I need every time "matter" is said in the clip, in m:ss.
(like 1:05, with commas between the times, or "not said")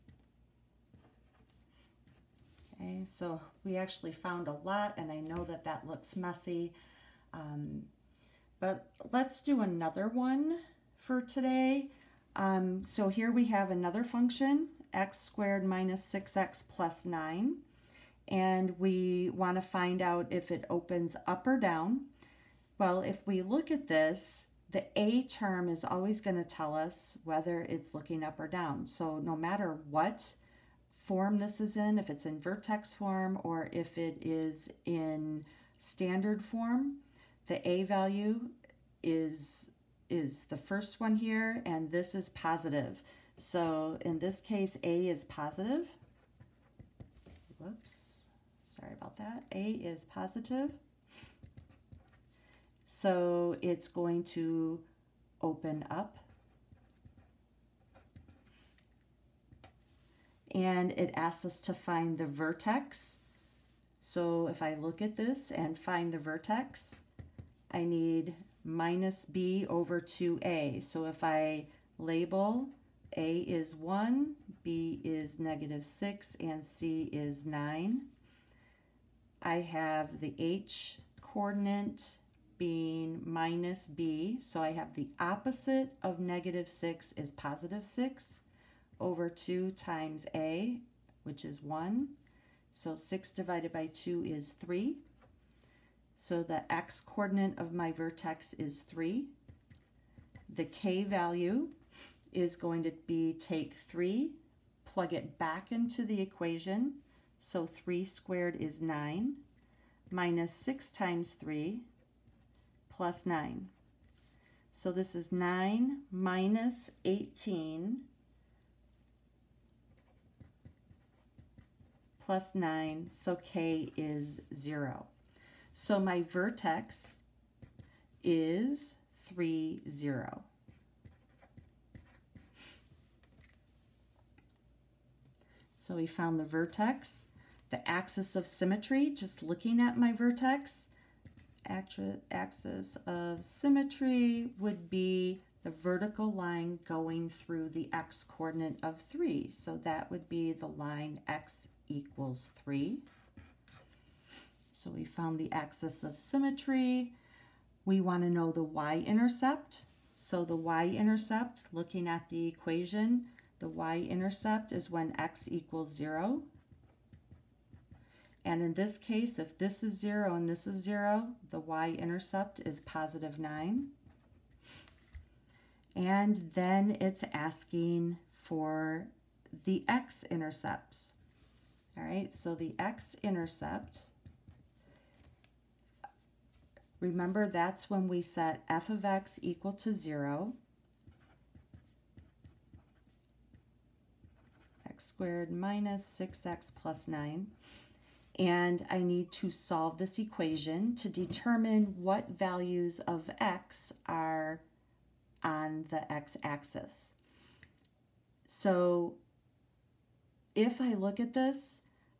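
0:29.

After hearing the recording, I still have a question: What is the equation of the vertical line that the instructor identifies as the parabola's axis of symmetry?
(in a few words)
x = 3.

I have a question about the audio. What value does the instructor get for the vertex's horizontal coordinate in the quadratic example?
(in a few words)
3.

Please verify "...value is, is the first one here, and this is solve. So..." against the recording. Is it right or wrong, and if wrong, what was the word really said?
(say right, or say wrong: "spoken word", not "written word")
wrong: "positive", not "solve".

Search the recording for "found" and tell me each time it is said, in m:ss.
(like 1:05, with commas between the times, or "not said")
0:04, 2:16, 2:35.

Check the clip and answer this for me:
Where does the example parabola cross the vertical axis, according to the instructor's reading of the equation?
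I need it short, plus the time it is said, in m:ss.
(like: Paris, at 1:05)
9, at 2:52.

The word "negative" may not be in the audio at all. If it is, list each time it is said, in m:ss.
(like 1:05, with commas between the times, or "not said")
1:15, 1:26.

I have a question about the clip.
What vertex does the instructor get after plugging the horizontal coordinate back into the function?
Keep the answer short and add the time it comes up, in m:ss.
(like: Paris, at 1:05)
(3, 0), at 2:09.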